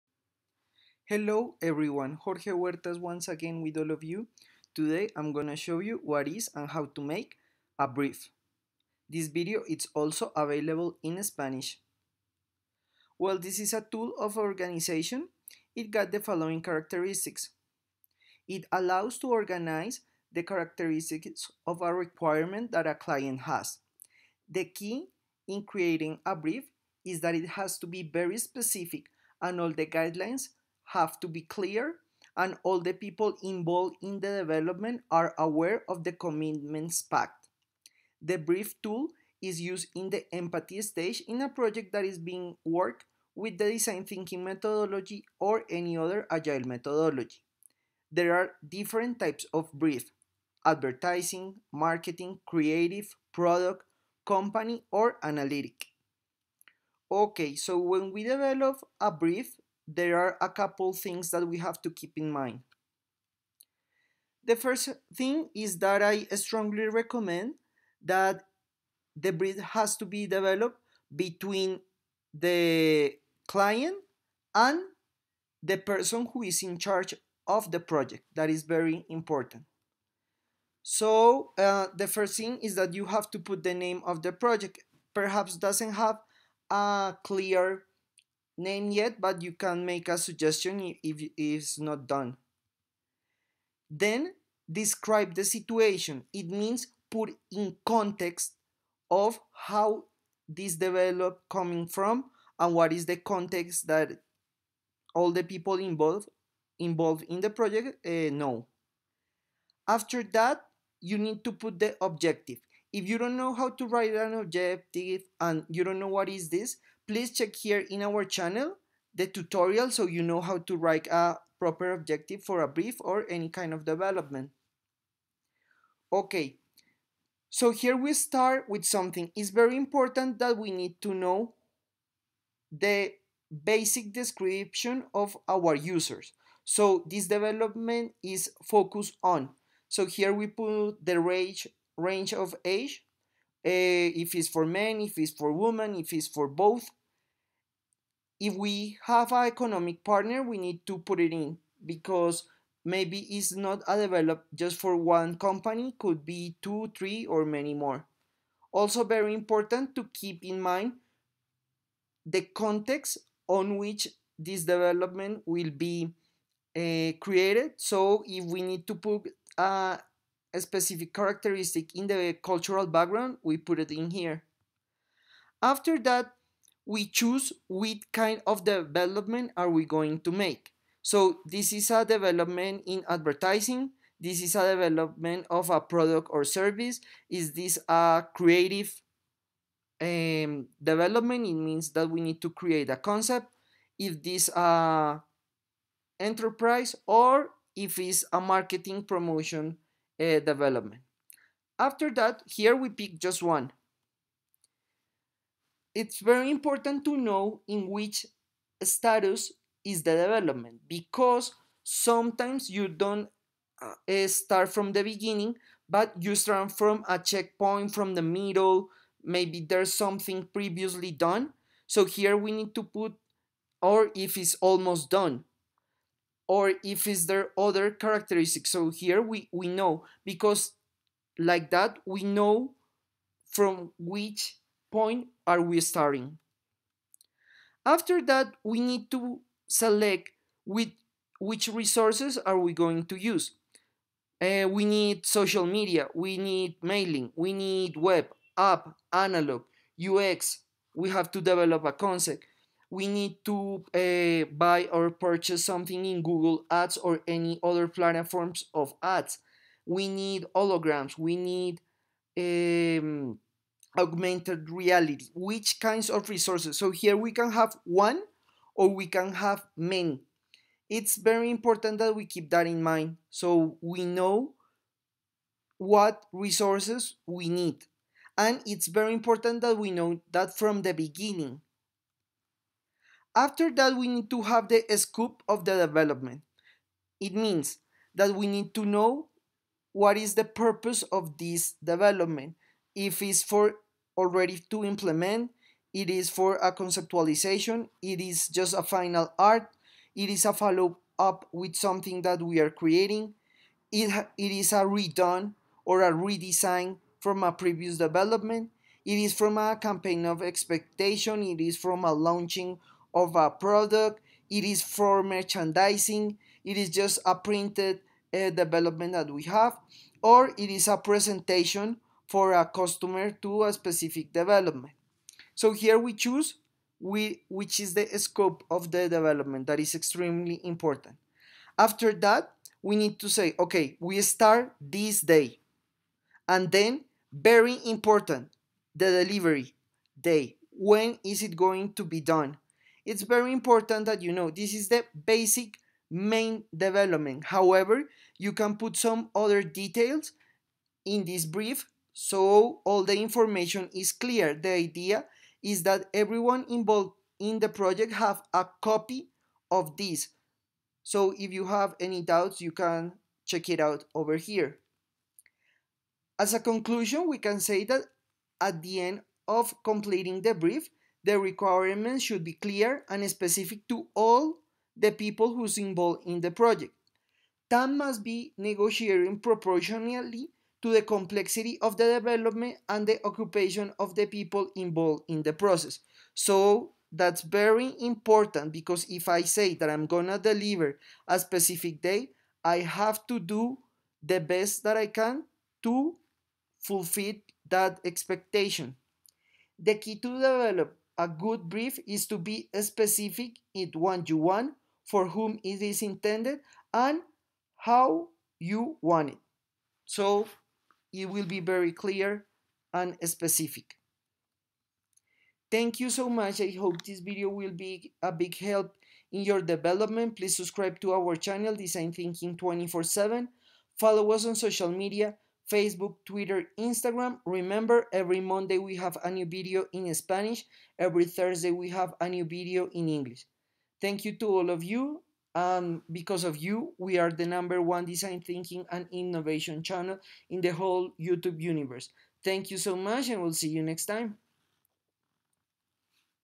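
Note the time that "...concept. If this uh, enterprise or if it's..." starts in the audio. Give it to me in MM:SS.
03:12.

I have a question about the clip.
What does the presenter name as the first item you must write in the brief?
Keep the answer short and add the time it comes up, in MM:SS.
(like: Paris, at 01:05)
Name of the project, at 01:23.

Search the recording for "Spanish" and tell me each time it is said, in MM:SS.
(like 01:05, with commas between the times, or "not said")
00:11, 07:10.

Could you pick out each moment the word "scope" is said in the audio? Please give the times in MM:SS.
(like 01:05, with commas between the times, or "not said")
04:44, 05:28.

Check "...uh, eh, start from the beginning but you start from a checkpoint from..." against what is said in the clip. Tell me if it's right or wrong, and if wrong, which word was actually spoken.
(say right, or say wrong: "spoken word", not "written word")
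right.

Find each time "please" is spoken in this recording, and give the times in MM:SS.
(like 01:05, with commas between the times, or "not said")
01:57, 07:00.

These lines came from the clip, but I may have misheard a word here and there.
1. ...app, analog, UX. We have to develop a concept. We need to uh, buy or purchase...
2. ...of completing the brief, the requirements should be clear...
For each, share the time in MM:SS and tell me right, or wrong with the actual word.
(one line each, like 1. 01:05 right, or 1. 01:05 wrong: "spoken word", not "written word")
1. 04:08 right
2. 06:09 right.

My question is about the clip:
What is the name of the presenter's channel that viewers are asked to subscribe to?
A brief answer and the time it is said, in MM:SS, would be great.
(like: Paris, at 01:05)
Design Thinking 24-7, at 07:01.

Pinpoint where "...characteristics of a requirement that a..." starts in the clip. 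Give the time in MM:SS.
00:20.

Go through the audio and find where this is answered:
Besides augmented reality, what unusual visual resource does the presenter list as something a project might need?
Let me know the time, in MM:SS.
04:20.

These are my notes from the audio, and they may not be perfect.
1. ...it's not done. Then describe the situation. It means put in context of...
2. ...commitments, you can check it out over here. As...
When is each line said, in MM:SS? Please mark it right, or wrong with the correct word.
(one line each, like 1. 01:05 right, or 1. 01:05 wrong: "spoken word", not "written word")
1. 01:31 right
2. 06:02 wrong: "doubts", not "commitments".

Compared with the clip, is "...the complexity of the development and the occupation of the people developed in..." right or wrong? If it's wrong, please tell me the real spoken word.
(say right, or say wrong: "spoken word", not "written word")
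wrong: "involved", not "developed".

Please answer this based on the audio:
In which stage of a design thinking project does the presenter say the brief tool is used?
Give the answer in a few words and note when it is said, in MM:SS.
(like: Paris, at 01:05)
Empathy stage, at 00:40.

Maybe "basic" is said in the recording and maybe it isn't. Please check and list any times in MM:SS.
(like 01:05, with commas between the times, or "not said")
02:13, 05:45.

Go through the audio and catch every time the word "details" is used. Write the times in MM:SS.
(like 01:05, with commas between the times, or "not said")
05:49.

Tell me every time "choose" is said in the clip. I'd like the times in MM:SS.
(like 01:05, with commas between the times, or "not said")
02:57, 05:26.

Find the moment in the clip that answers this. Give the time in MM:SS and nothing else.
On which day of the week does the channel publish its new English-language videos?
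07:11.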